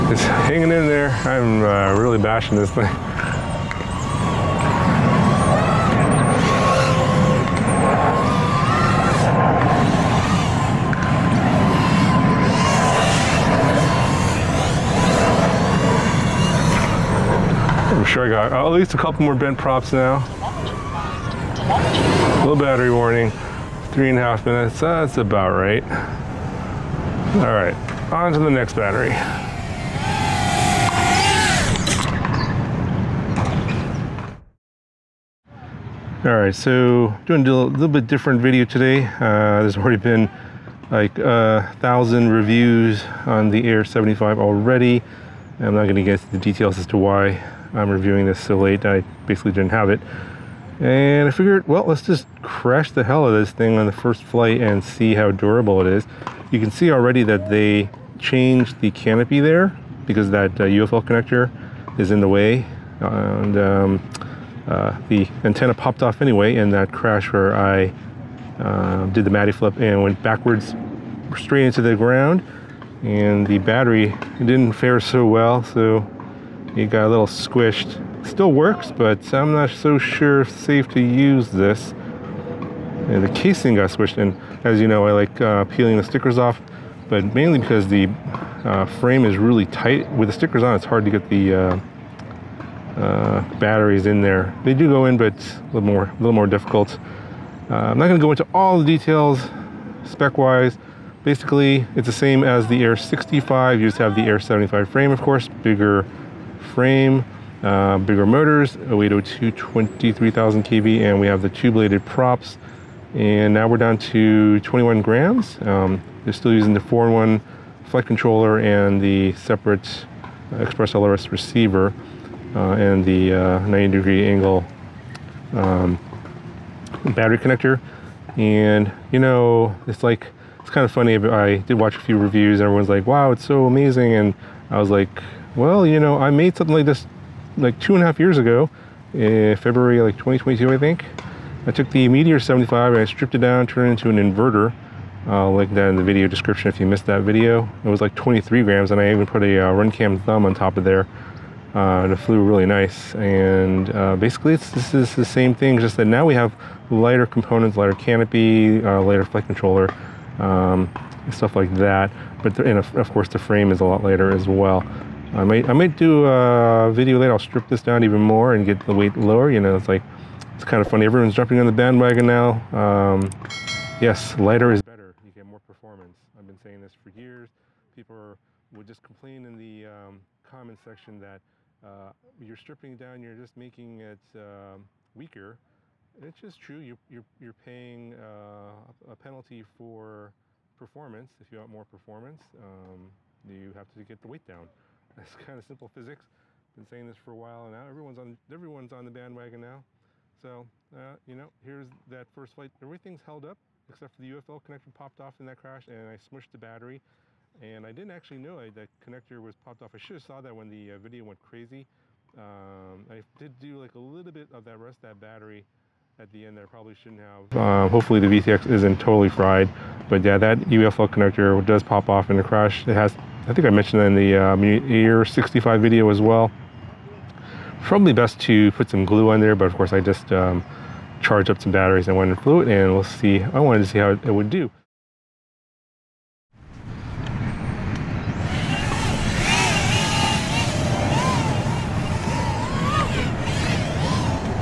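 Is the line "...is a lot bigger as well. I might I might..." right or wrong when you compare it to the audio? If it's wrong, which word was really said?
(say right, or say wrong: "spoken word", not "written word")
wrong: "lighter", not "bigger".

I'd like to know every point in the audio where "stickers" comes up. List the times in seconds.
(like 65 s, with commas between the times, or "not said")
86 s, 90 s.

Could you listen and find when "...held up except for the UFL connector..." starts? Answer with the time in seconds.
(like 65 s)
203 s.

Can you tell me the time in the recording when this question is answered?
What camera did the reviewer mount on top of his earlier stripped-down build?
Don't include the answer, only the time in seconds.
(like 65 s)
149 s.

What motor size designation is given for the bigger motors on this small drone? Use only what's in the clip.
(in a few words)
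0802.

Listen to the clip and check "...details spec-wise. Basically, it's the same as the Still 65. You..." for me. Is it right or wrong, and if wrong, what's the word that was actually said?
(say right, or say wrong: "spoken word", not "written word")
wrong: "Air", not "Still".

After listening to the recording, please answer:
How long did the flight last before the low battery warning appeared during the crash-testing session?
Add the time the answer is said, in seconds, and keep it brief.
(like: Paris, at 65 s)
3.5 minutes, at 23 s.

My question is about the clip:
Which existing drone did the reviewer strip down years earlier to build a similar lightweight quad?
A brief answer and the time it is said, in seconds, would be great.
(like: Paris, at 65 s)
Meteor 75, at 142 s.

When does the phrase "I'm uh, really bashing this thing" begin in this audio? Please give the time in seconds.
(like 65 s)
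1 s.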